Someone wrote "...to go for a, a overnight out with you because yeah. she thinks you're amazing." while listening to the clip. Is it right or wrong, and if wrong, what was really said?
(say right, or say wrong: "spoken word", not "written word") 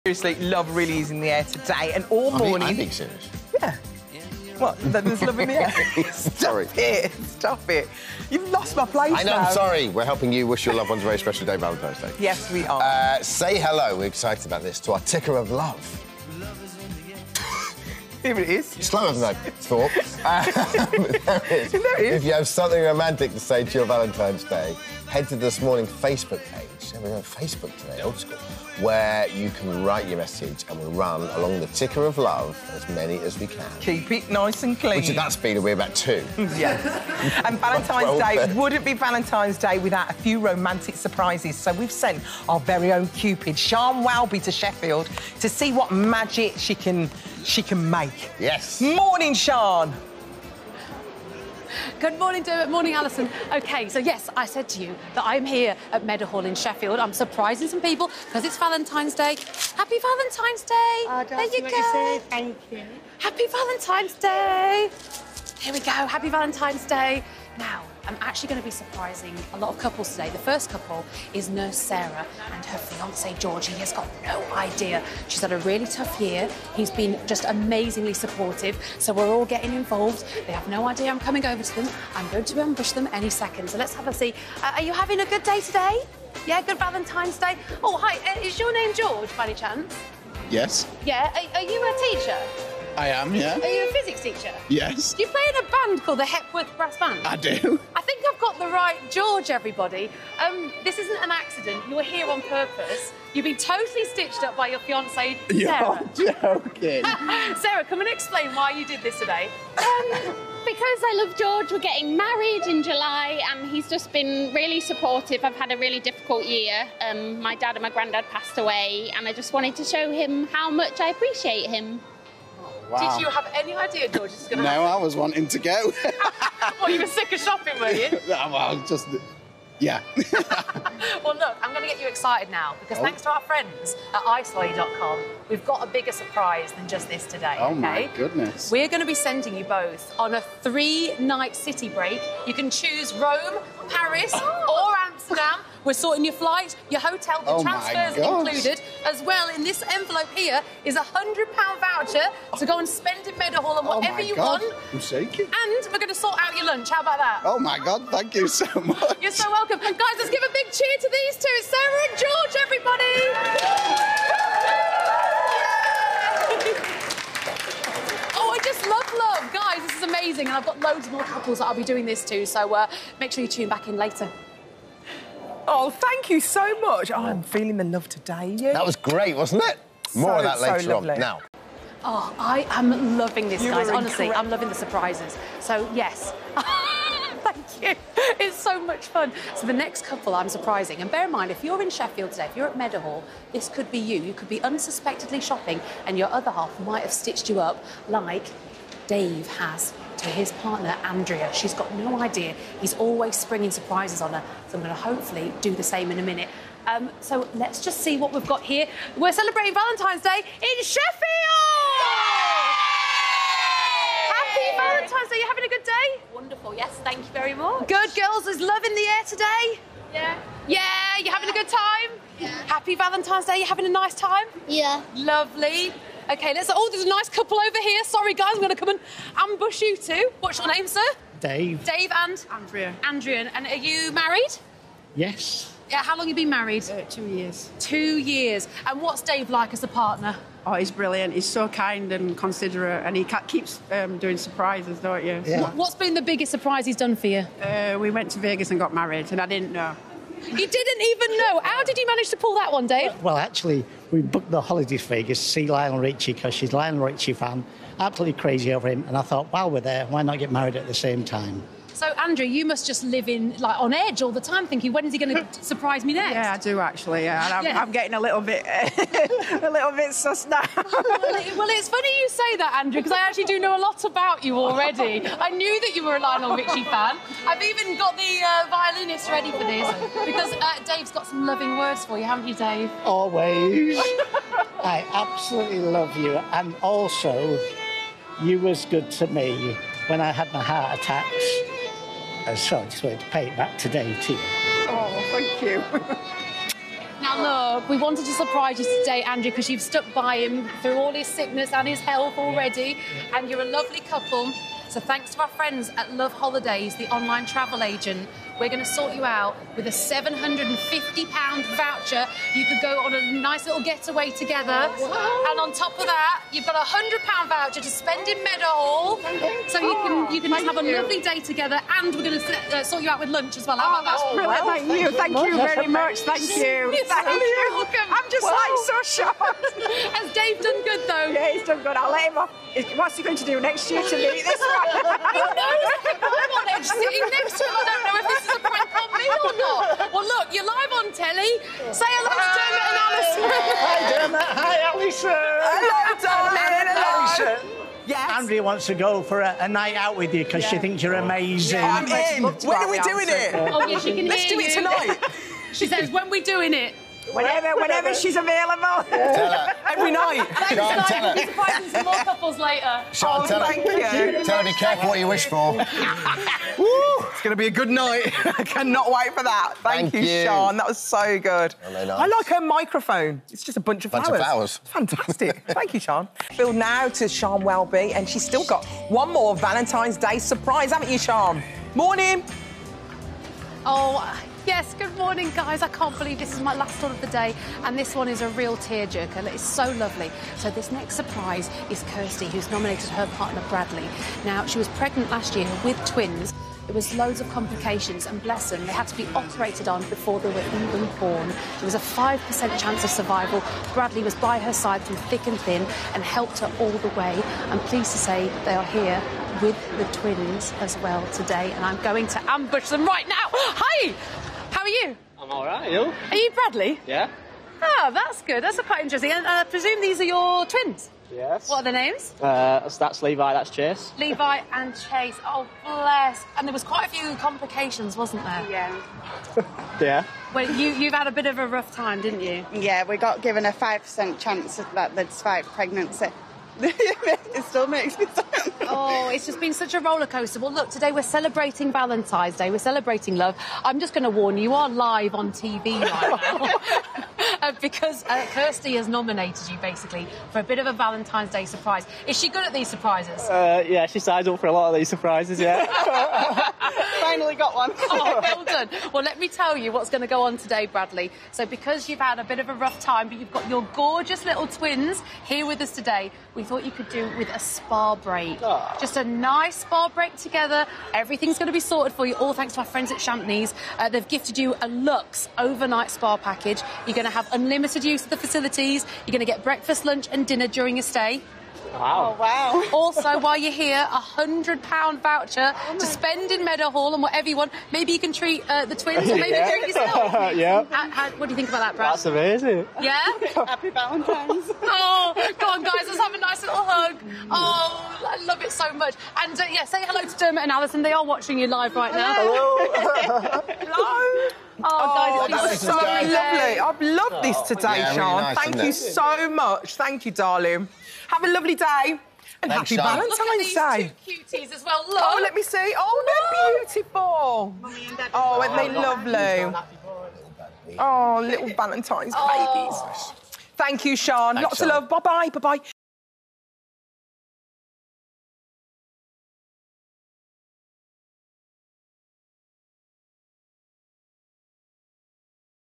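wrong: "night", not "overnight".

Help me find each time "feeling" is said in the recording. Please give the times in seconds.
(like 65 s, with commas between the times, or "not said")
177 s.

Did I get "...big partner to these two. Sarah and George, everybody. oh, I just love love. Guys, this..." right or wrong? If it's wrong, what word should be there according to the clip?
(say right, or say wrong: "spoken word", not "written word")
wrong: "cheer", not "partner".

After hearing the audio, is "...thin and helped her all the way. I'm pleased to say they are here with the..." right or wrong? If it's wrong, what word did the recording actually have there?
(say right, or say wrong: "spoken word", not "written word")
right.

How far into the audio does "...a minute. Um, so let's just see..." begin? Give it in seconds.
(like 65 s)
206 s.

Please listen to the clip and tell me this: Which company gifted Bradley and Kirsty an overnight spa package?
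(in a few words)
Champneys.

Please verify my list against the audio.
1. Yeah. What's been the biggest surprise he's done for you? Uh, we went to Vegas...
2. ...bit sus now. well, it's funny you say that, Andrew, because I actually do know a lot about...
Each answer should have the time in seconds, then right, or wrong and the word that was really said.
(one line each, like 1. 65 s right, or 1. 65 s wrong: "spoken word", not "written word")
1. 245 s right
2. 269 s right.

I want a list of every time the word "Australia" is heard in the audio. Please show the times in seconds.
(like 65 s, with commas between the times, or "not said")
not said.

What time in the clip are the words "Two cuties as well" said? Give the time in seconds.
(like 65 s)
514 s.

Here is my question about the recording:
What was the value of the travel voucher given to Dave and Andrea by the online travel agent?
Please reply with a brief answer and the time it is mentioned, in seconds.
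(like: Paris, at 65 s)
£750, at 309 s.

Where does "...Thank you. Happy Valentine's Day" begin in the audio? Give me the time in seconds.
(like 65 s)
62 s.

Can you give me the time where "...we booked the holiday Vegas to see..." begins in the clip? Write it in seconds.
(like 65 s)
254 s.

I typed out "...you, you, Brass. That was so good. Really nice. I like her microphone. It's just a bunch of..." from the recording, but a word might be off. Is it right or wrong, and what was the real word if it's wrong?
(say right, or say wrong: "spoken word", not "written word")
wrong: "Sian", not "Brass".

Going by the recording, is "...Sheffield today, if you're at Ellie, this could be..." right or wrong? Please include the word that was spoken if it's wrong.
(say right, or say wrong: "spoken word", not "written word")
wrong: "Meadowhall", not "Ellie".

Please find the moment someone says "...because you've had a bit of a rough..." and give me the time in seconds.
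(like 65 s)
461 s.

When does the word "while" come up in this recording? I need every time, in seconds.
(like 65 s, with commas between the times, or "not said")
259 s, 483 s.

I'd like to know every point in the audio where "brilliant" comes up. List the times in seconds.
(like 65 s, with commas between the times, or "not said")
240 s, 324 s.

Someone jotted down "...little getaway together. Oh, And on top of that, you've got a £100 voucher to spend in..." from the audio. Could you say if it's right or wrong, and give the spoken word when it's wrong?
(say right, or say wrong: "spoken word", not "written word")
right.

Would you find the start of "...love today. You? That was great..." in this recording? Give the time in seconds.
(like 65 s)
177 s.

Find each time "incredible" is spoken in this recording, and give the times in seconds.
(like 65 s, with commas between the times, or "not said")
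184 s.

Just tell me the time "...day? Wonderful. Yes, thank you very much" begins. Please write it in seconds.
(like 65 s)
215 s.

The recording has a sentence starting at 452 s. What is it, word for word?
Is she good at these surprises?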